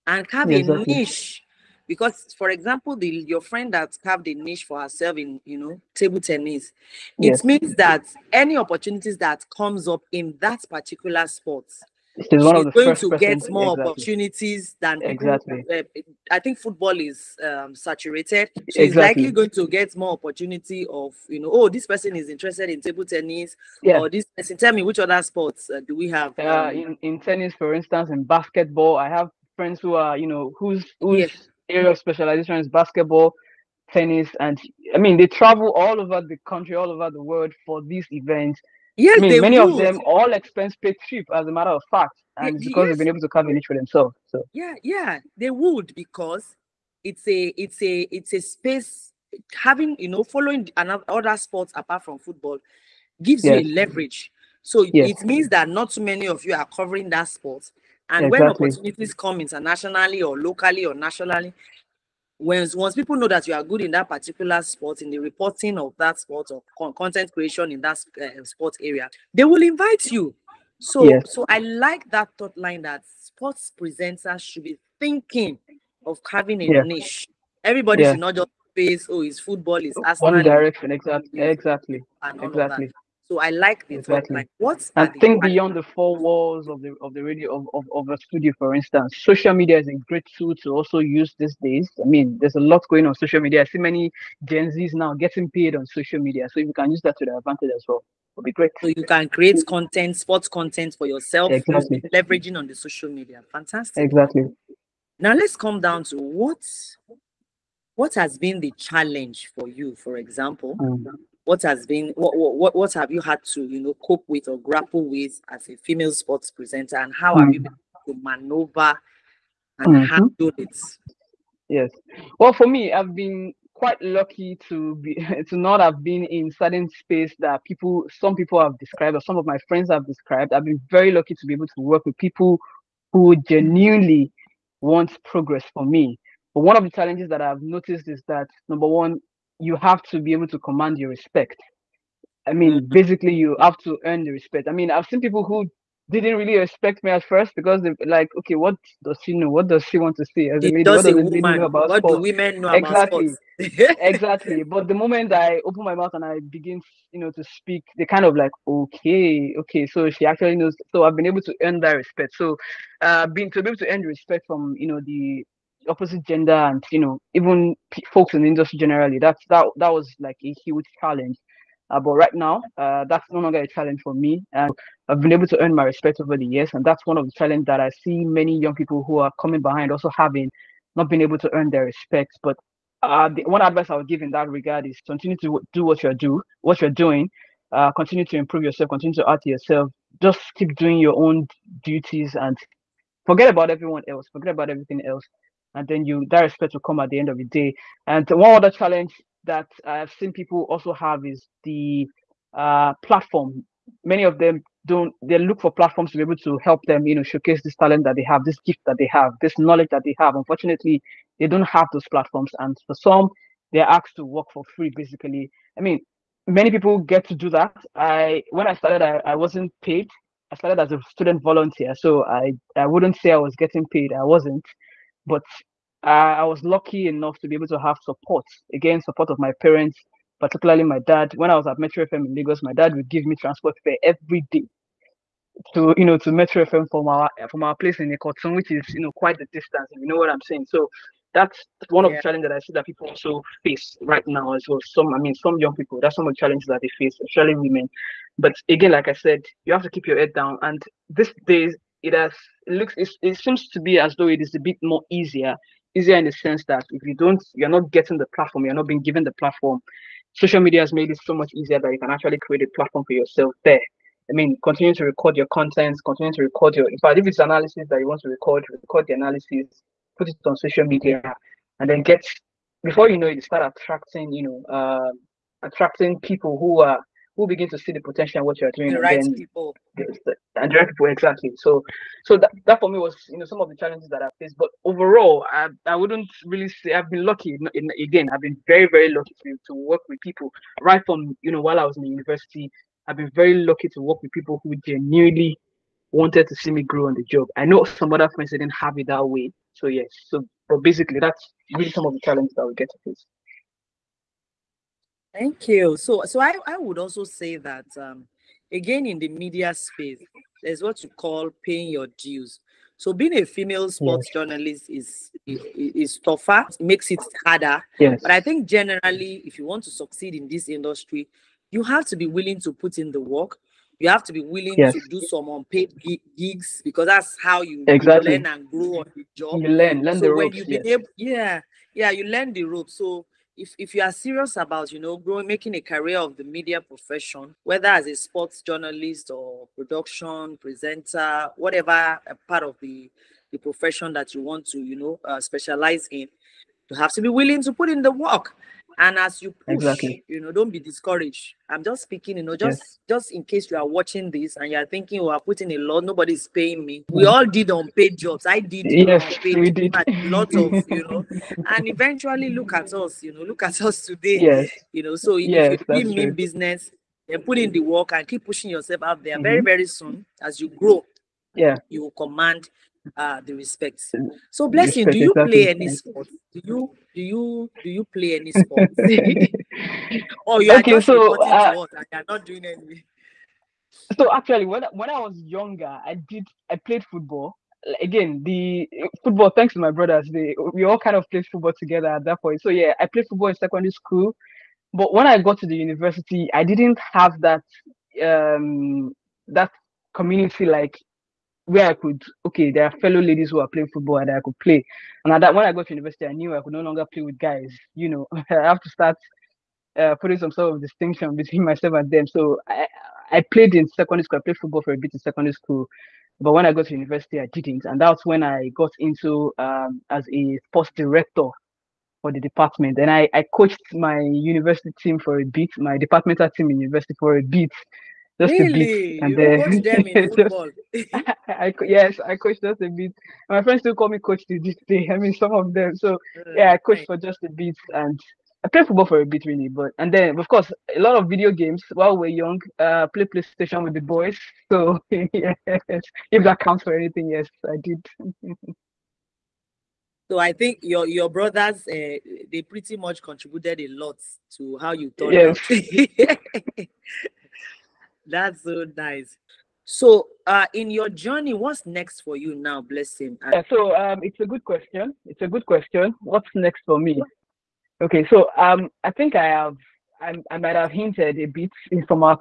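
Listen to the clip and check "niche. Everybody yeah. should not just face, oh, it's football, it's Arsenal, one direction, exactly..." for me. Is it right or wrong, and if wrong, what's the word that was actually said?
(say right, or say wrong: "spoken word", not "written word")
right.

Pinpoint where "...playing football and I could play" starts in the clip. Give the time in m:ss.
6:43.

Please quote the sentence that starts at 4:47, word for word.
In, again, I've been very, very lucky to, to work with people right from, you know, while I was in the university.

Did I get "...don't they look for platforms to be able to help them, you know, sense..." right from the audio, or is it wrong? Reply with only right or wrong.
wrong.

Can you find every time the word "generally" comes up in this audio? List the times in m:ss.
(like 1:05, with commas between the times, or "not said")
2:48, 5:18.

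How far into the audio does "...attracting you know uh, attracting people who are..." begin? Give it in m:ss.
4:33.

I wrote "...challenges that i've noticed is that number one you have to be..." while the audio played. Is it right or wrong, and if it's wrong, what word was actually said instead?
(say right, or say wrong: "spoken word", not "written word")
right.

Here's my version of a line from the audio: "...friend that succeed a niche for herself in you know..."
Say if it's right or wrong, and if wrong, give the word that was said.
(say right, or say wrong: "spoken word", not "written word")
wrong: "carved", not "succeed".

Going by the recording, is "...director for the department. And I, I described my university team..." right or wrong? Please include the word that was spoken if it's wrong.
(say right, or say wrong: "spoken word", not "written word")
wrong: "coached", not "described".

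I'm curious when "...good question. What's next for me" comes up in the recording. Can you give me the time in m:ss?
7:45.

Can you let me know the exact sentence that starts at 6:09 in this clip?
very very soon as you grow yeah you will command uh the respect so blessing respect, do you exactly.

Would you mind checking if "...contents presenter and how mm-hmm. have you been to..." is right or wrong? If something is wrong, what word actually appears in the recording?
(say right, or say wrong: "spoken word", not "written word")
wrong: "sports", not "contents".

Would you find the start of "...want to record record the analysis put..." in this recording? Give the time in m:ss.
4:28.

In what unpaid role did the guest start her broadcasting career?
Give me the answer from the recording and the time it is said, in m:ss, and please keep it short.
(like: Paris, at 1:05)
Student volunteer, at 3:41.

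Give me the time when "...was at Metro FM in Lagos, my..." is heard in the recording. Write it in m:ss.
3:51.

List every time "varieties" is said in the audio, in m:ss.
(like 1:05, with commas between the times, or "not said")
not said.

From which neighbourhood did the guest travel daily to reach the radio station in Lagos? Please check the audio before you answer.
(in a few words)
Ikotun.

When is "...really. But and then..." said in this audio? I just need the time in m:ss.
7:19.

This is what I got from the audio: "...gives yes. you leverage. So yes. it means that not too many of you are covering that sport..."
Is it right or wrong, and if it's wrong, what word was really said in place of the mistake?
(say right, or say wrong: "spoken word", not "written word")
right.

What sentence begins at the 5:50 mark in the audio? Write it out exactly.
you know don't be discouraged i'm just speaking you know just yes.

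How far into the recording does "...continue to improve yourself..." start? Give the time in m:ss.
3:07.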